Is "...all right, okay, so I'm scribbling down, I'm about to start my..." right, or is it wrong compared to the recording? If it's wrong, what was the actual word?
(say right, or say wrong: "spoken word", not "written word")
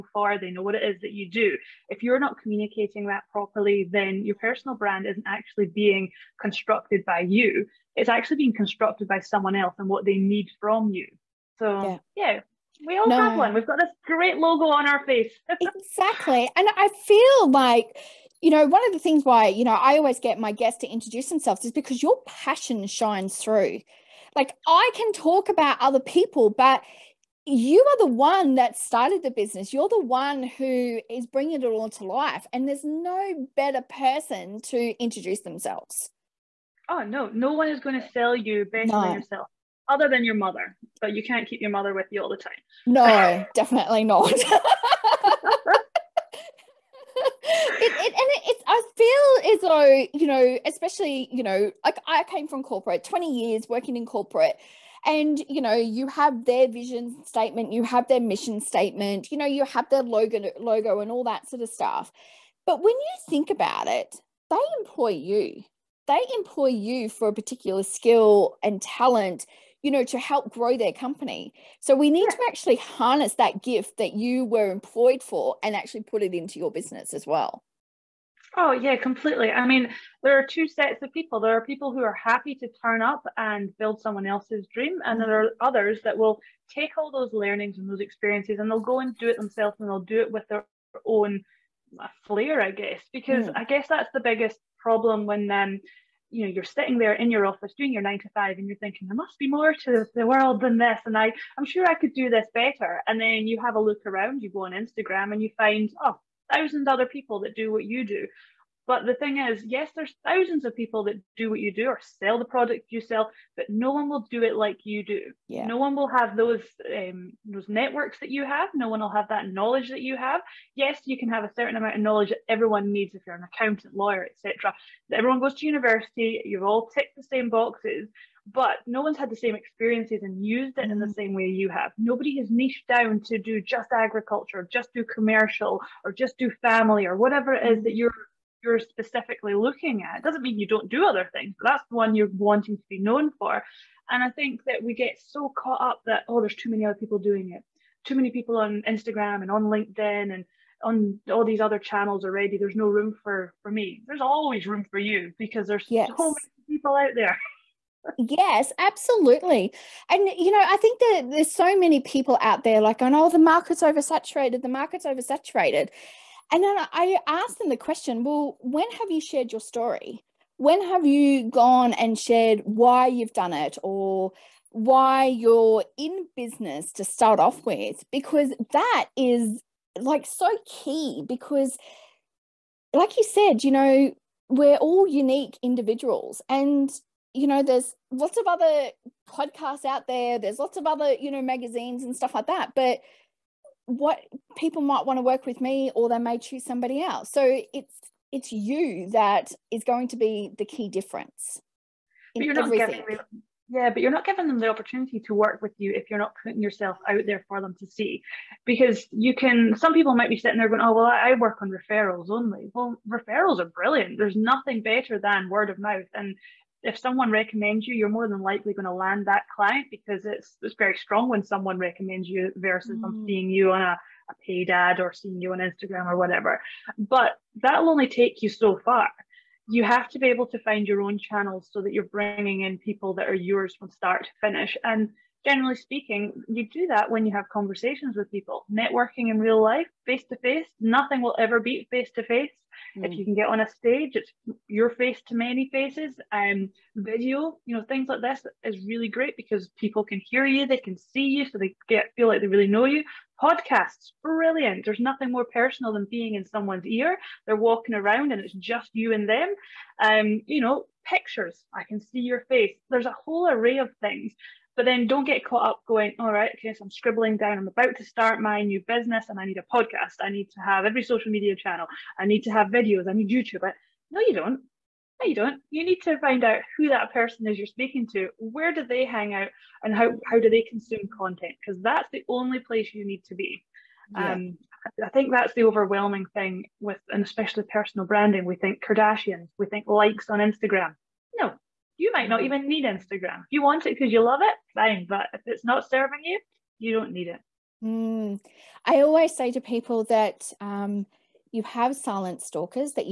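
right.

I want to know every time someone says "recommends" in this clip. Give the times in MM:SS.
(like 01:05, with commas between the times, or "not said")
03:37, 03:41.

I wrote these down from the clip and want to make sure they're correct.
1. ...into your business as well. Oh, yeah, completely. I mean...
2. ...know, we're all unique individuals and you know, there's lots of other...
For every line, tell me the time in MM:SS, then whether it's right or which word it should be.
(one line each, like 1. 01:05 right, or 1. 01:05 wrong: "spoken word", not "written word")
1. 01:16 right
2. 03:03 right.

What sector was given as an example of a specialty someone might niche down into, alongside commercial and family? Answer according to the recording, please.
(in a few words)
Agriculture.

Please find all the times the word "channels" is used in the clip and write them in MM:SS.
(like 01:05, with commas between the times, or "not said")
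02:31, 03:51, 04:31.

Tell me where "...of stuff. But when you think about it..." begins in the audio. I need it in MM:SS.
01:01.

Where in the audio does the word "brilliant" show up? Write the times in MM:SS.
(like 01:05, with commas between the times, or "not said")
03:33, 04:14.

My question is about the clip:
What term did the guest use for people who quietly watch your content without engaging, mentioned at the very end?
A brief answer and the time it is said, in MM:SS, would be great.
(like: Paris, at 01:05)
Silent stalkers, at 05:01.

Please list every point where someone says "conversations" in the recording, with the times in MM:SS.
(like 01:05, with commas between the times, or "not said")
03:57.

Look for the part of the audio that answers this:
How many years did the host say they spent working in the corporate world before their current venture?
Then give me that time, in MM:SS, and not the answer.
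00:53.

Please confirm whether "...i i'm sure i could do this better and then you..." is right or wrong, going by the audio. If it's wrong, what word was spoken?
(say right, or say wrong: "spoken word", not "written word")
right.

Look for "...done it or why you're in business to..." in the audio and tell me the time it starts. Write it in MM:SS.
02:53.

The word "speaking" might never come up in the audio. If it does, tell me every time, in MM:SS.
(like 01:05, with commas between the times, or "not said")
03:55, 04:37.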